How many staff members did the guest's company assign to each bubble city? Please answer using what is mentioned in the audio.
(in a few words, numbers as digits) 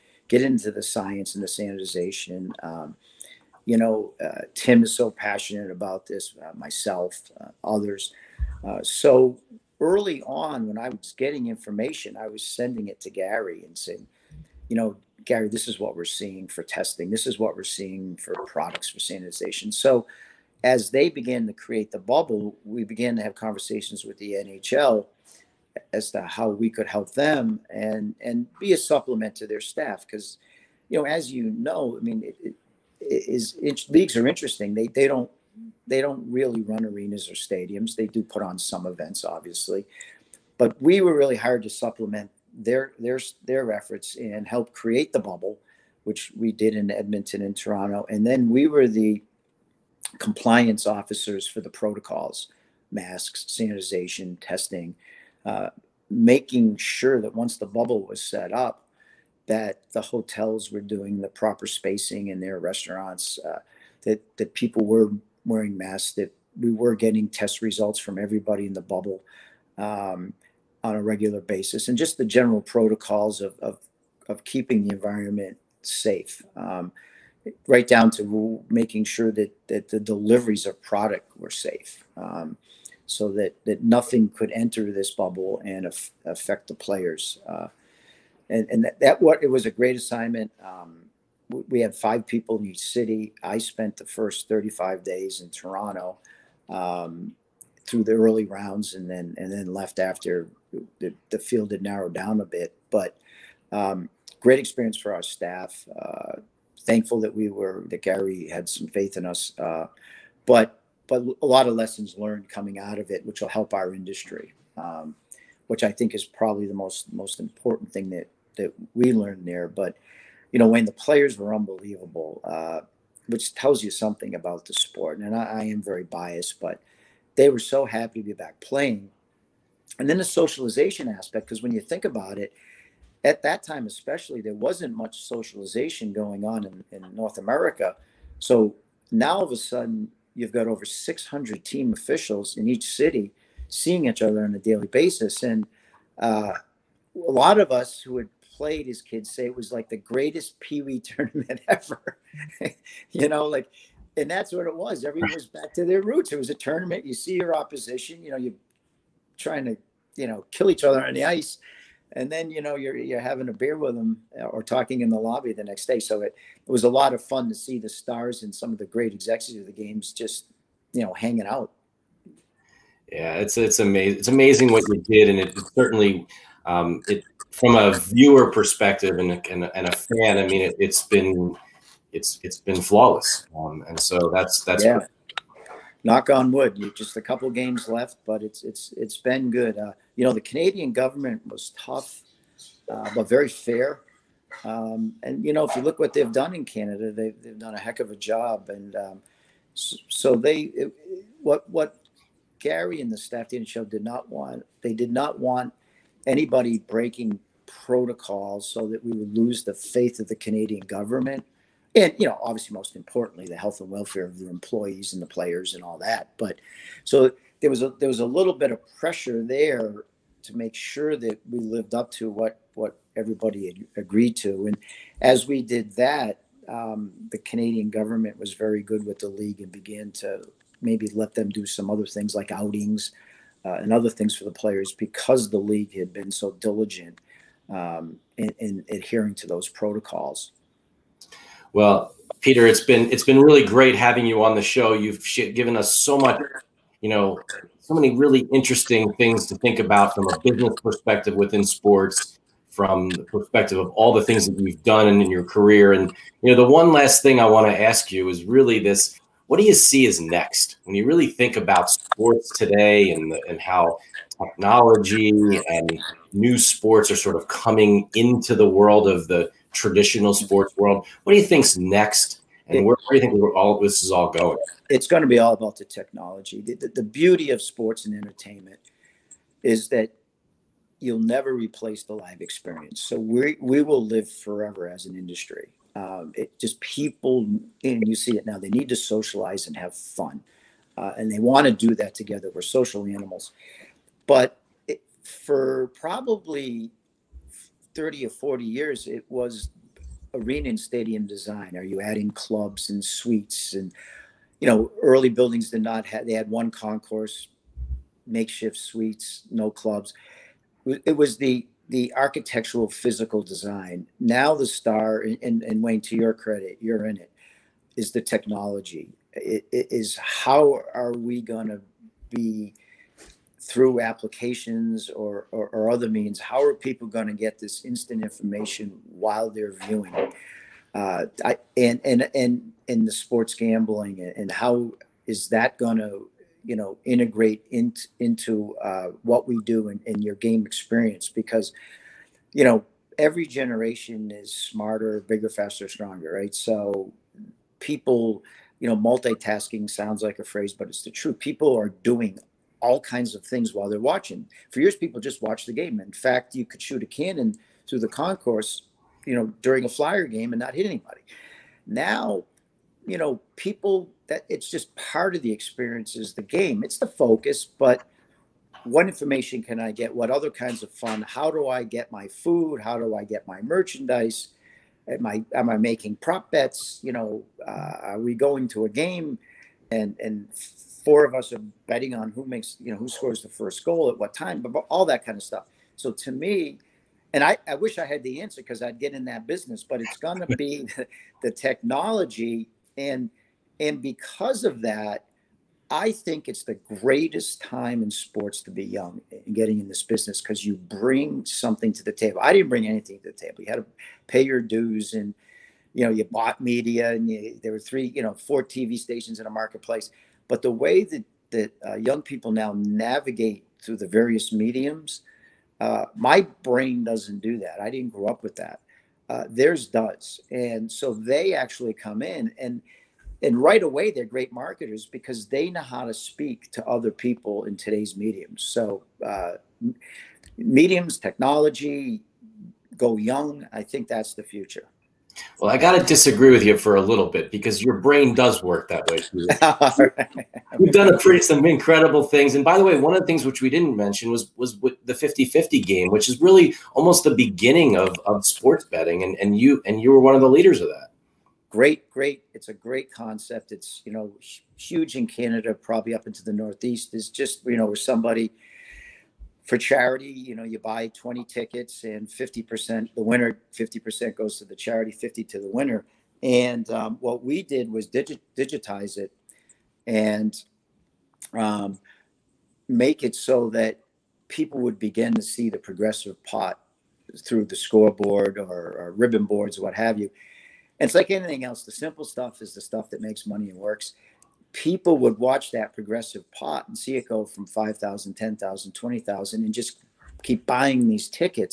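5.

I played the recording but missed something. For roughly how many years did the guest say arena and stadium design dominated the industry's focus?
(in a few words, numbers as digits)
30 or 40.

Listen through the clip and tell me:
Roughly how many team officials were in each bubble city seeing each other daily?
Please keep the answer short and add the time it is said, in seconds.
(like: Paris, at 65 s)
over 600, at 140 s.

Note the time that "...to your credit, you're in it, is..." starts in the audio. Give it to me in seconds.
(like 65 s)
316 s.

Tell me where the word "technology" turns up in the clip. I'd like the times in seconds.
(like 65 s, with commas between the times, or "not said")
264 s, 275 s, 318 s, 391 s, 431 s.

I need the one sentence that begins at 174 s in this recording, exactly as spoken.
It's amazing what you did, and it certainly um, it from a viewer perspective and, and, and a fan.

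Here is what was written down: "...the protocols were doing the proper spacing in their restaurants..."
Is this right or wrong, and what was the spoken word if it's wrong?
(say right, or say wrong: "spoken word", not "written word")
wrong: "hotels", not "protocols".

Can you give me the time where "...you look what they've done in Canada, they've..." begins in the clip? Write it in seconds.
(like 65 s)
195 s.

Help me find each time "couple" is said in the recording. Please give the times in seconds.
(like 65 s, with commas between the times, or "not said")
187 s.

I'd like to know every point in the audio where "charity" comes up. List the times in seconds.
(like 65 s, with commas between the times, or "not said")
459 s, 464 s.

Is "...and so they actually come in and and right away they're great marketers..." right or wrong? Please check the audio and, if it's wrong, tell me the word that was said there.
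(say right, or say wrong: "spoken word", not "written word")
right.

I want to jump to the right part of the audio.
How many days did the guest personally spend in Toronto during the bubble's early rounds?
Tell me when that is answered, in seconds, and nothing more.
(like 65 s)
94 s.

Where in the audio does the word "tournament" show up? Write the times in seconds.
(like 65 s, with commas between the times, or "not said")
150 s, 156 s.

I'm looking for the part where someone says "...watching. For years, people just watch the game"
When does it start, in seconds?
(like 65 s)
353 s.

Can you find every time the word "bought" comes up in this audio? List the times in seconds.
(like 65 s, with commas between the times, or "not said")
406 s.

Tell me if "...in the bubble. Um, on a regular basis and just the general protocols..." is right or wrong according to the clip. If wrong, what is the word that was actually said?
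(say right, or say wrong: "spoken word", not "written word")
right.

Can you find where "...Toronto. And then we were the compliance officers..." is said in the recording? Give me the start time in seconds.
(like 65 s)
47 s.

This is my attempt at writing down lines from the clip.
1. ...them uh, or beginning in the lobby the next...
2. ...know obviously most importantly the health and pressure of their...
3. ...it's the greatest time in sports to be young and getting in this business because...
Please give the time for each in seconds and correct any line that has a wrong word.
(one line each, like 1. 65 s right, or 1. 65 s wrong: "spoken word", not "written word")
1. 163 s wrong: "talking", not "beginning"
2. 212 s wrong: "welfare", not "pressure"
3. 396 s right.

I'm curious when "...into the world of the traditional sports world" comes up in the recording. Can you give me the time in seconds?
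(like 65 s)
268 s.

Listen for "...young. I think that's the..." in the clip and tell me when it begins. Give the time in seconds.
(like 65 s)
433 s.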